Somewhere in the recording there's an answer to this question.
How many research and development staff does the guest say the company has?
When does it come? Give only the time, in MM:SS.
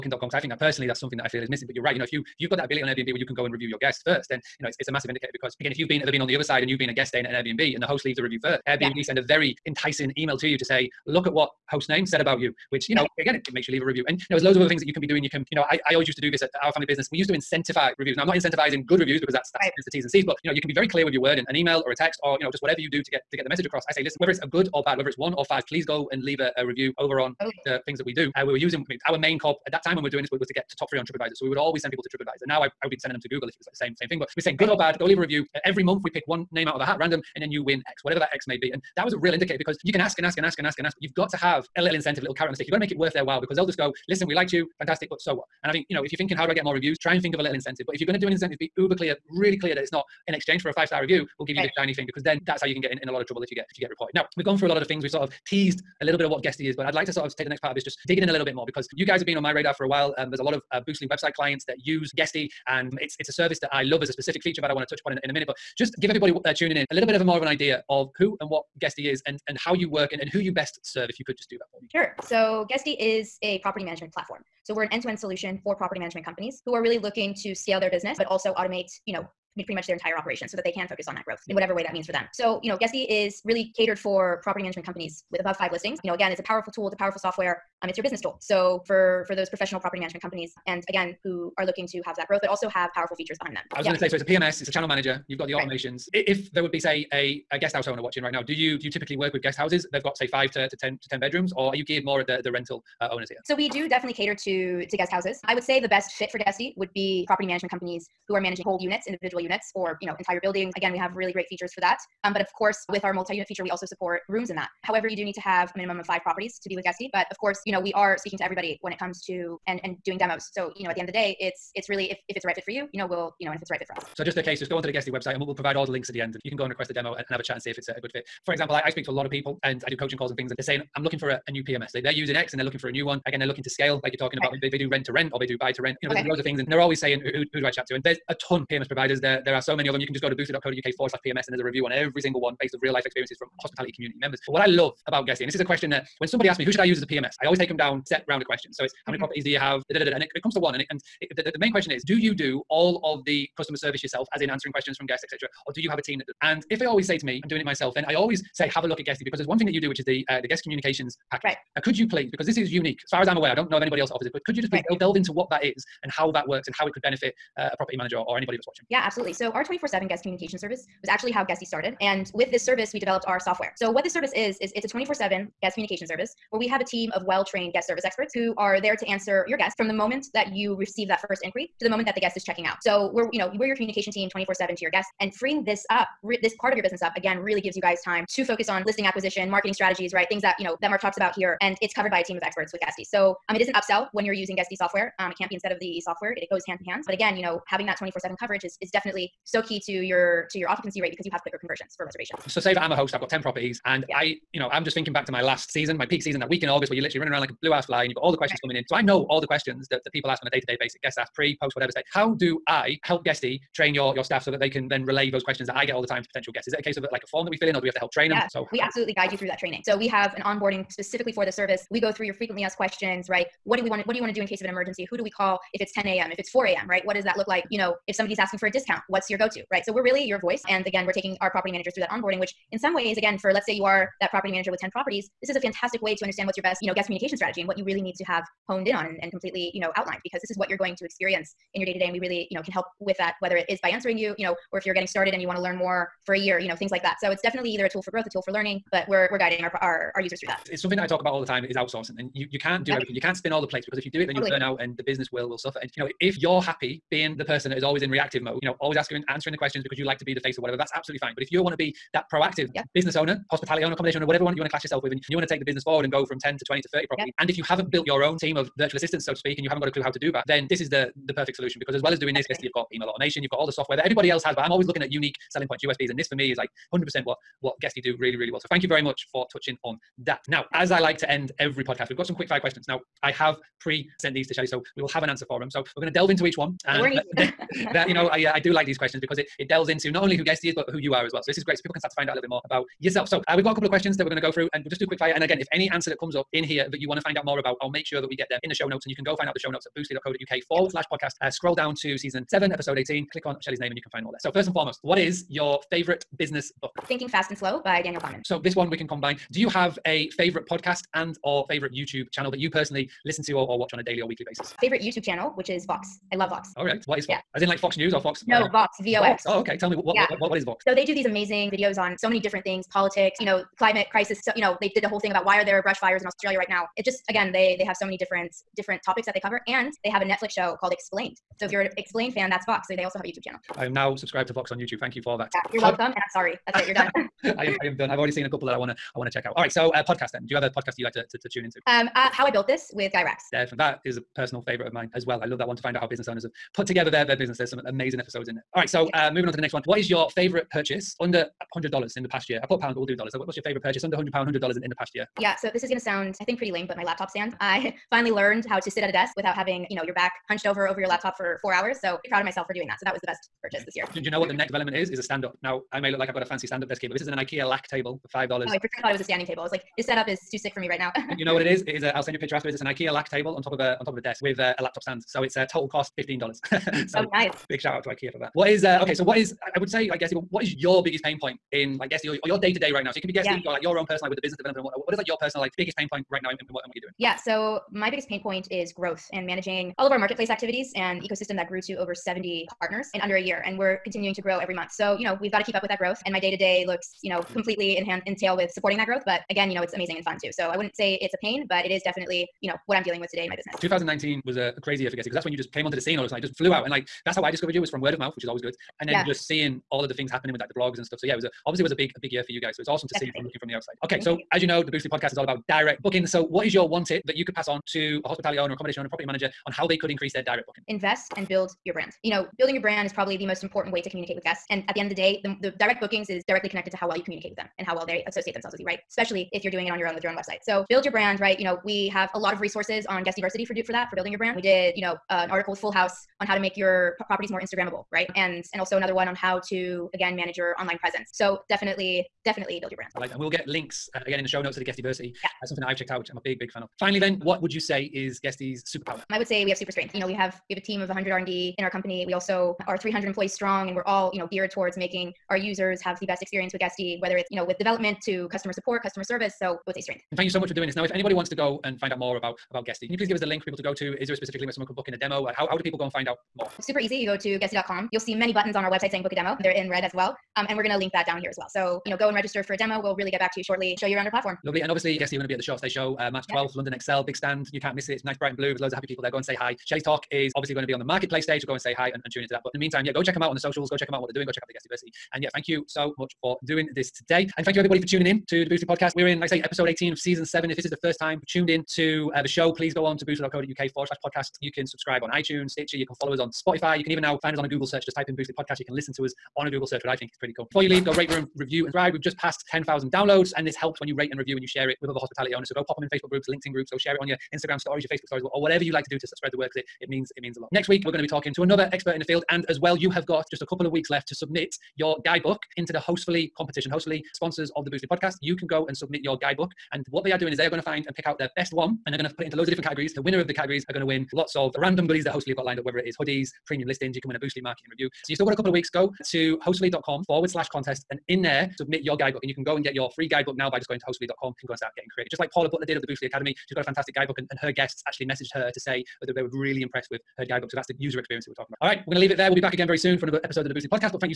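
07:31.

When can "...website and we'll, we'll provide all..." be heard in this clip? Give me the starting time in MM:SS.
02:05.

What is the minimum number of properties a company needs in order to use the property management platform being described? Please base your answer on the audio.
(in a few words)
5.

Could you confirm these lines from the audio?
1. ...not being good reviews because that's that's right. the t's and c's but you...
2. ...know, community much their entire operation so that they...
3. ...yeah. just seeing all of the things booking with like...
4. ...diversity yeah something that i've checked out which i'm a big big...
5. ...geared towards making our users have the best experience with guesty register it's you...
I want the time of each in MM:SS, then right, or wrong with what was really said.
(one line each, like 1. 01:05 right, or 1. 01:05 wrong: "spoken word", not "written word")
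1. 00:18 wrong: "incentivizing", not "being"
2. 01:19 wrong: "pretty", not "community"
3. 06:49 wrong: "happening", not "booking"
4. 07:24 right
5. 07:34 wrong: "whether", not "register".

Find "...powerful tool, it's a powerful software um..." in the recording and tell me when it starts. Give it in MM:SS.
01:26.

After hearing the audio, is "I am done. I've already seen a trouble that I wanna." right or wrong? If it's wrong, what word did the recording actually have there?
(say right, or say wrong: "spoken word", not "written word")
wrong: "couple", not "trouble".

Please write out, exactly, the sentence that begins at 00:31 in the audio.
So we would always send people to TripAdvisor.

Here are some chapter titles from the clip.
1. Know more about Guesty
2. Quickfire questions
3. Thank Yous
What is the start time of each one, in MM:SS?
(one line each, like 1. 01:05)
1. 00:44
2. 04:10
3. 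07:04.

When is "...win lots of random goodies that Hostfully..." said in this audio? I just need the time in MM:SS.
08:44.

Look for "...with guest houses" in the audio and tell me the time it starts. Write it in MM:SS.
01:39.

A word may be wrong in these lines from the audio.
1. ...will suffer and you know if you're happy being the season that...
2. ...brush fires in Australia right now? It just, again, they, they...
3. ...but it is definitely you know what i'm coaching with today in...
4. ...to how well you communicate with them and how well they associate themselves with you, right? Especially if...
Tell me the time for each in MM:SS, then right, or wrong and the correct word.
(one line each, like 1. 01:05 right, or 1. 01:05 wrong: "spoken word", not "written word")
1. 04:15 wrong: "person", not "season"
2. 05:25 right
3. 06:41 wrong: "dealing", not "coaching"
4. 07:06 right.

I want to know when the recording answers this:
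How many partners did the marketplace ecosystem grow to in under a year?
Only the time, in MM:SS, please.
06:31.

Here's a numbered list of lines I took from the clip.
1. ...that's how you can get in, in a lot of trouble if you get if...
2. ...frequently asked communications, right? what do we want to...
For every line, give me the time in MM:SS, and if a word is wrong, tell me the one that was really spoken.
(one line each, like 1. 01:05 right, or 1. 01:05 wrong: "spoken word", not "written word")
1. 00:52 right
2. 03:42 wrong: "questions", not "communications".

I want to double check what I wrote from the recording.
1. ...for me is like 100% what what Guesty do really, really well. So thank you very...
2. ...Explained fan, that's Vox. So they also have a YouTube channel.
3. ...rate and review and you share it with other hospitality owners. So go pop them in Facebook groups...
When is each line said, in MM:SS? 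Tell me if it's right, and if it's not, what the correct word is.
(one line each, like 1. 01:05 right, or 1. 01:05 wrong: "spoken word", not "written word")
1. 04:36 right
2. 05:31 right
3. 08:24 right.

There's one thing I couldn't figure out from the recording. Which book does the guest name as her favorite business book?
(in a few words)
Thinking Fast and Slow.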